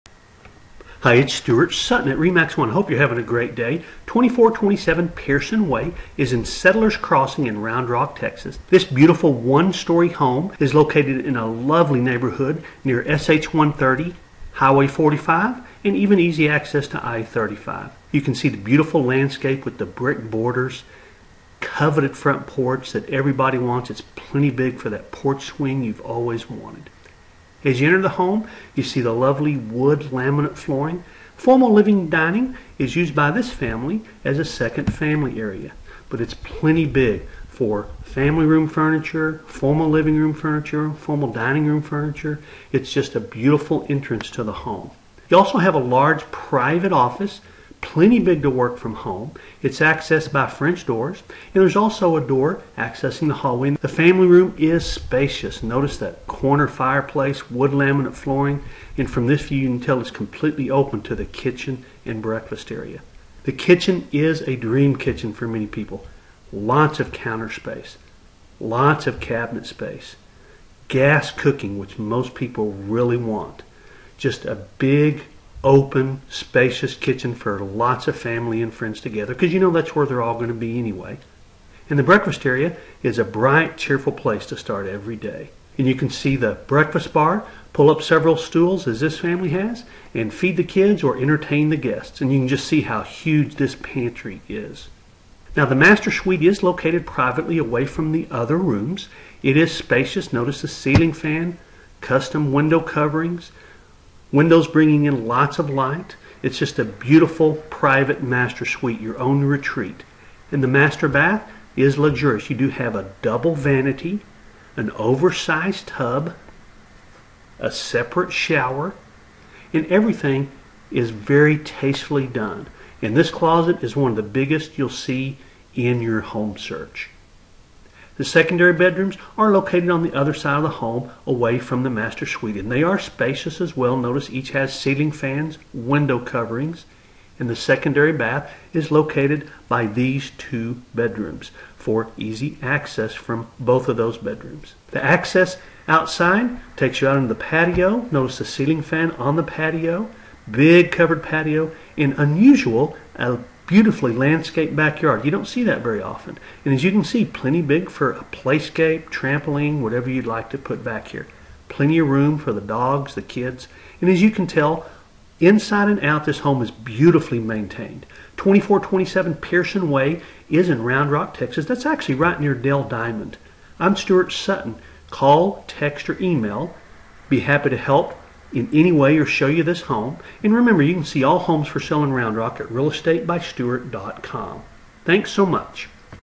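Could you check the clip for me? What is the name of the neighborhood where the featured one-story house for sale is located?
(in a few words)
Settlers Crossing.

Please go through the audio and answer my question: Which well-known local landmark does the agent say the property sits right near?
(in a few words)
Dell Diamond.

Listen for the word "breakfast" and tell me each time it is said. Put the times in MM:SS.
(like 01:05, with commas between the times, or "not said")
01:02, 01:22, 01:26.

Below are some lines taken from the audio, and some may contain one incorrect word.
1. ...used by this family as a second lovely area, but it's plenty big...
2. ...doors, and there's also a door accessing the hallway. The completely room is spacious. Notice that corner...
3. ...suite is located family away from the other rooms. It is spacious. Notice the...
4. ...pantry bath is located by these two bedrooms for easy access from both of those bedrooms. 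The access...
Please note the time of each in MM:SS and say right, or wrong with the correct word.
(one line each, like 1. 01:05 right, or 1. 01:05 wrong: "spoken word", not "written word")
1. 00:32 wrong: "family", not "lovely"
2. 00:50 wrong: "family", not "completely"
3. 01:36 wrong: "privately", not "family"
4. 02:17 wrong: "secondary", not "pantry".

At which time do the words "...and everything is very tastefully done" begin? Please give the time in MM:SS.
01:59.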